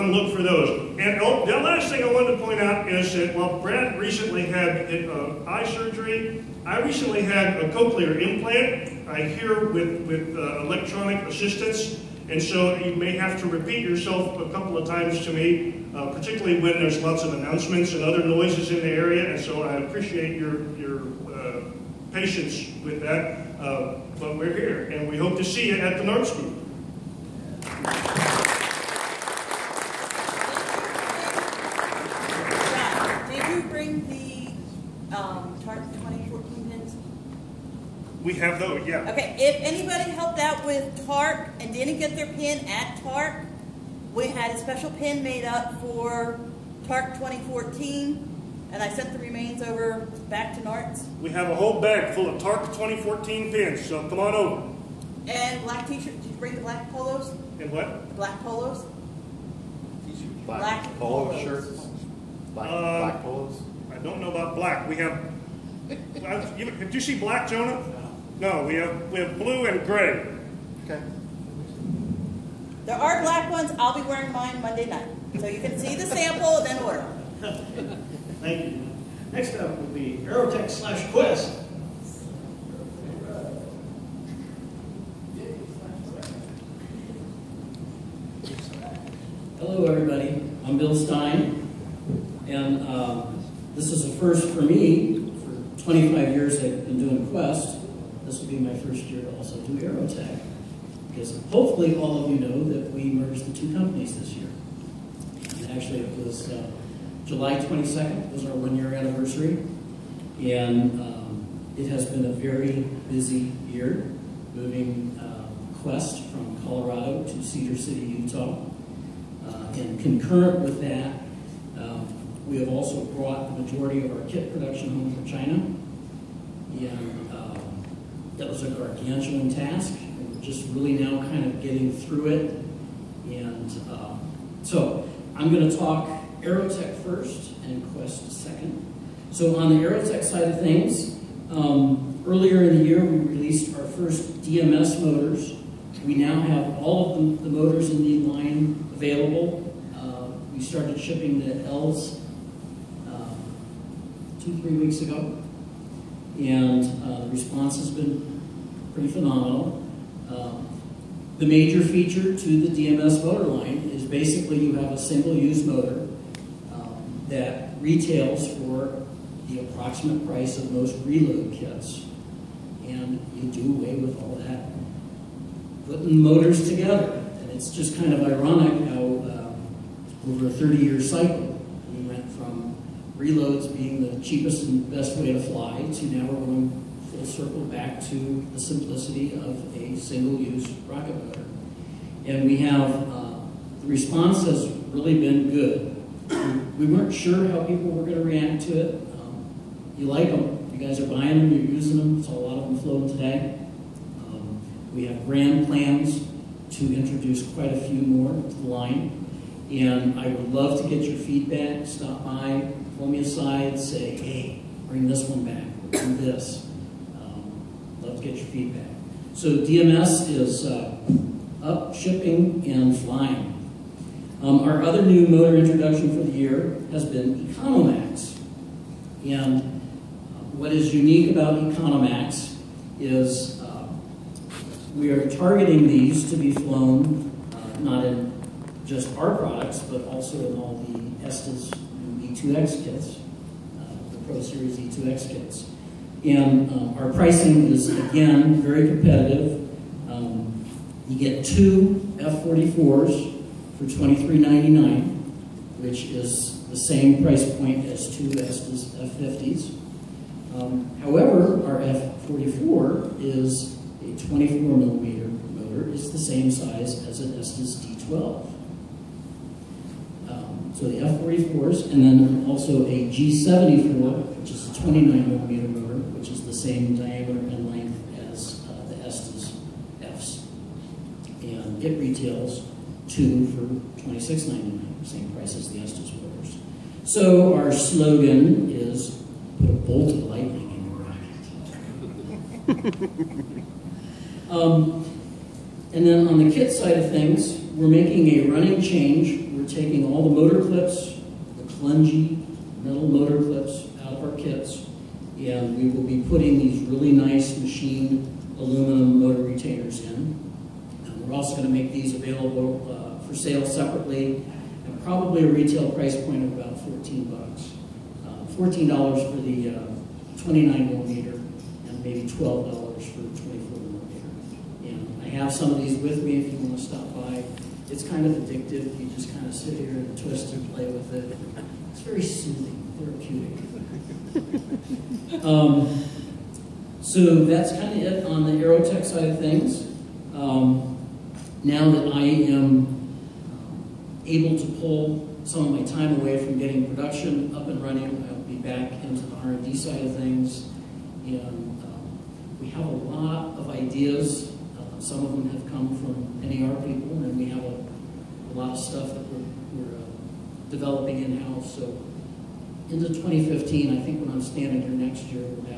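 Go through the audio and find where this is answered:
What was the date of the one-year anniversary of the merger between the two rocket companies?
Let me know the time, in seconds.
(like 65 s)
107 s.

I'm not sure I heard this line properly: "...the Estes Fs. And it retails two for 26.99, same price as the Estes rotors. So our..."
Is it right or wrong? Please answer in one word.
right.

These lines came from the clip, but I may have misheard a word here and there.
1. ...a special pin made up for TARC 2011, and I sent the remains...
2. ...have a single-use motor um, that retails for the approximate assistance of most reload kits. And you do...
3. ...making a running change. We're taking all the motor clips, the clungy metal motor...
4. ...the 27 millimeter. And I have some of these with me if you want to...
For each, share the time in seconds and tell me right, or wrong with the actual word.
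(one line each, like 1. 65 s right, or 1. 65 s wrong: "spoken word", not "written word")
1. 44 s wrong: "2014", not "2011"
2. 164 s wrong: "price", not "assistance"
3. 297 s right
4. 323 s wrong: "24", not "27".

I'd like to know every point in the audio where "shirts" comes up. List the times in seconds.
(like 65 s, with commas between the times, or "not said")
55 s, 61 s.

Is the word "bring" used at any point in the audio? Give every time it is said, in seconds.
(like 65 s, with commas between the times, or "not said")
56 s, 214 s.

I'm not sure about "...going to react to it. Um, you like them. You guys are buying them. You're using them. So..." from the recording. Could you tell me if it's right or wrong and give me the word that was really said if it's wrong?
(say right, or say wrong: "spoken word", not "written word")
right.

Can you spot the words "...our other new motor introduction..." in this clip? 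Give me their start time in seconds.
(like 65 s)
224 s.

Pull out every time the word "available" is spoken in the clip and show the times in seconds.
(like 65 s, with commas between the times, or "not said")
148 s, 312 s.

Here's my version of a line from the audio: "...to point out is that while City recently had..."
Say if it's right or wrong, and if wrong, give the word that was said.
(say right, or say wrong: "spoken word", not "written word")
wrong: "Brad", not "City".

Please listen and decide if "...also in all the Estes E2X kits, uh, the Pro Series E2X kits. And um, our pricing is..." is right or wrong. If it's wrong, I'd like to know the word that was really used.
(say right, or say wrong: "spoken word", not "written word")
right.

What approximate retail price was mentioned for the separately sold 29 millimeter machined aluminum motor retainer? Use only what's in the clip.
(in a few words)
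$14.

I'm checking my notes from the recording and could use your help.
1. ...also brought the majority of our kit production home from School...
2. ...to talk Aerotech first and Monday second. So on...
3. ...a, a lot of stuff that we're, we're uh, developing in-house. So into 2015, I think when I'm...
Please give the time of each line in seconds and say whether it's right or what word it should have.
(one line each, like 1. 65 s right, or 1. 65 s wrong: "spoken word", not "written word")
1. 122 s wrong: "China", not "School"
2. 135 s wrong: "Quest", not "Monday"
3. 357 s right.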